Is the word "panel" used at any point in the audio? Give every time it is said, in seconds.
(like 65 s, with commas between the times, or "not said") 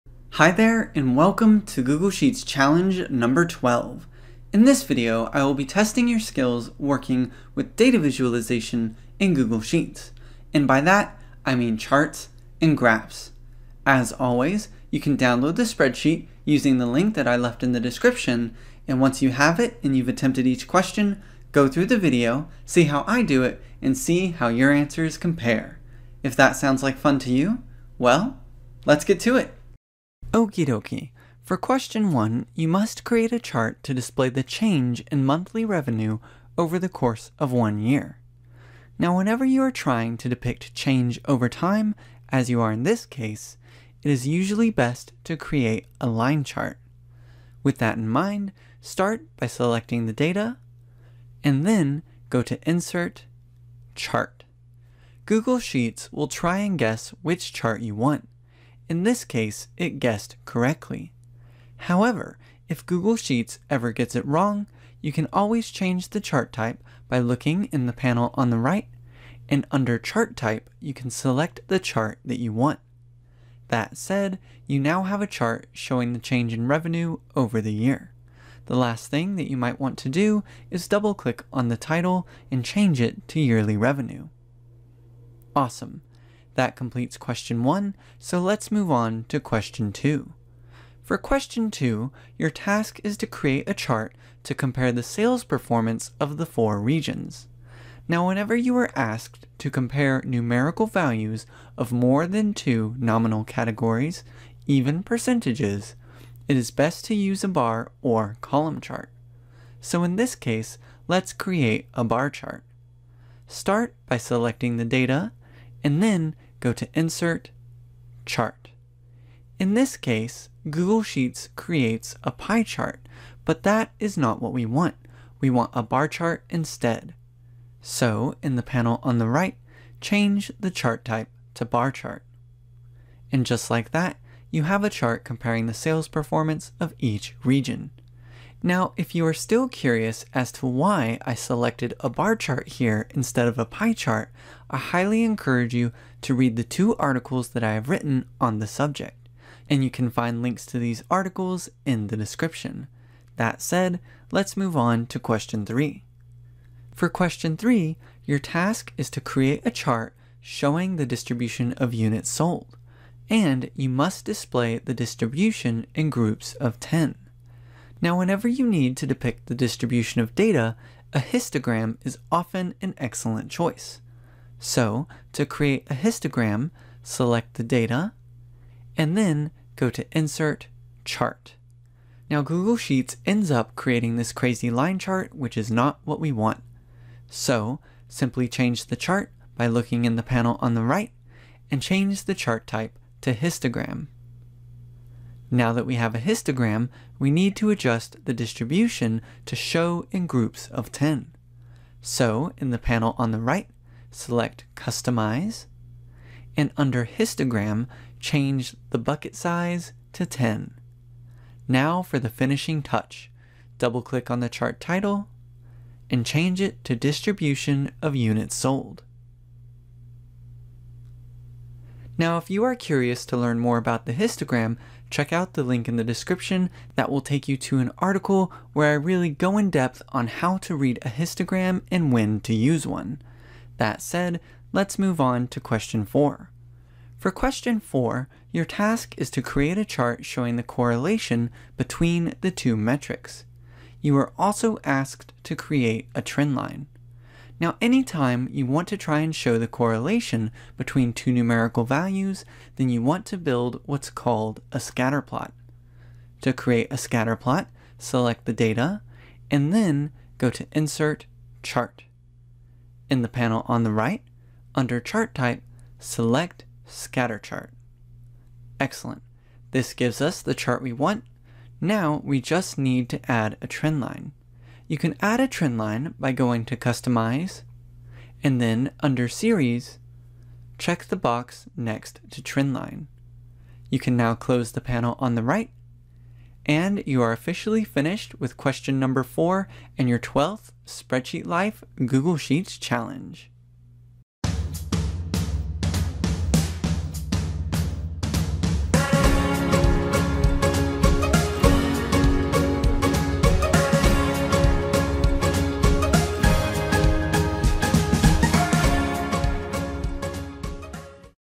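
67 s, 128 s, 190 s, 202 s, 263 s, 284 s.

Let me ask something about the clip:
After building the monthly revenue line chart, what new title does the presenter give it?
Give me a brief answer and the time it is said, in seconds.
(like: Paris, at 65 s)
yearly revenue, at 83 s.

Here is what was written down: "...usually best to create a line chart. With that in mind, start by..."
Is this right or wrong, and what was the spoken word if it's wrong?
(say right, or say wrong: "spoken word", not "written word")
right.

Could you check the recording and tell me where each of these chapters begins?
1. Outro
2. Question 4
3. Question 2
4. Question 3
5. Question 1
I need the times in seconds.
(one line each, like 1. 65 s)
1. 294 s
2. 237 s
3. 90 s
4. 157 s
5. 30 s.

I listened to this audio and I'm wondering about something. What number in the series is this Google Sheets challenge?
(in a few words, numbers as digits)
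12.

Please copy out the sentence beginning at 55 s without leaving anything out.
Google Sheets will try and guess which chart you want.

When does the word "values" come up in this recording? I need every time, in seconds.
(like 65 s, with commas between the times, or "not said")
100 s, 251 s.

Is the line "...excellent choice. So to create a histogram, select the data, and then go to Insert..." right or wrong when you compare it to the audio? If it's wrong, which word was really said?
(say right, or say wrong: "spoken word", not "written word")
right.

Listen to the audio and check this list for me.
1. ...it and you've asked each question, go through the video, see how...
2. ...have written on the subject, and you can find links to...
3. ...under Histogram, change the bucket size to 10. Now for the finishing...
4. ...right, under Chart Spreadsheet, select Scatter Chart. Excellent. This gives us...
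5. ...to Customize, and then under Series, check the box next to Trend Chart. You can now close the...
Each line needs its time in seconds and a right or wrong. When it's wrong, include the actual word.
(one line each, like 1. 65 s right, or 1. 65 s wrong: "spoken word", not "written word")
1. 19 s wrong: "attempted", not "asked"
2. 147 s right
3. 206 s right
4. 263 s wrong: "Type", not "Spreadsheet"
5. 276 s wrong: "Line", not "Chart".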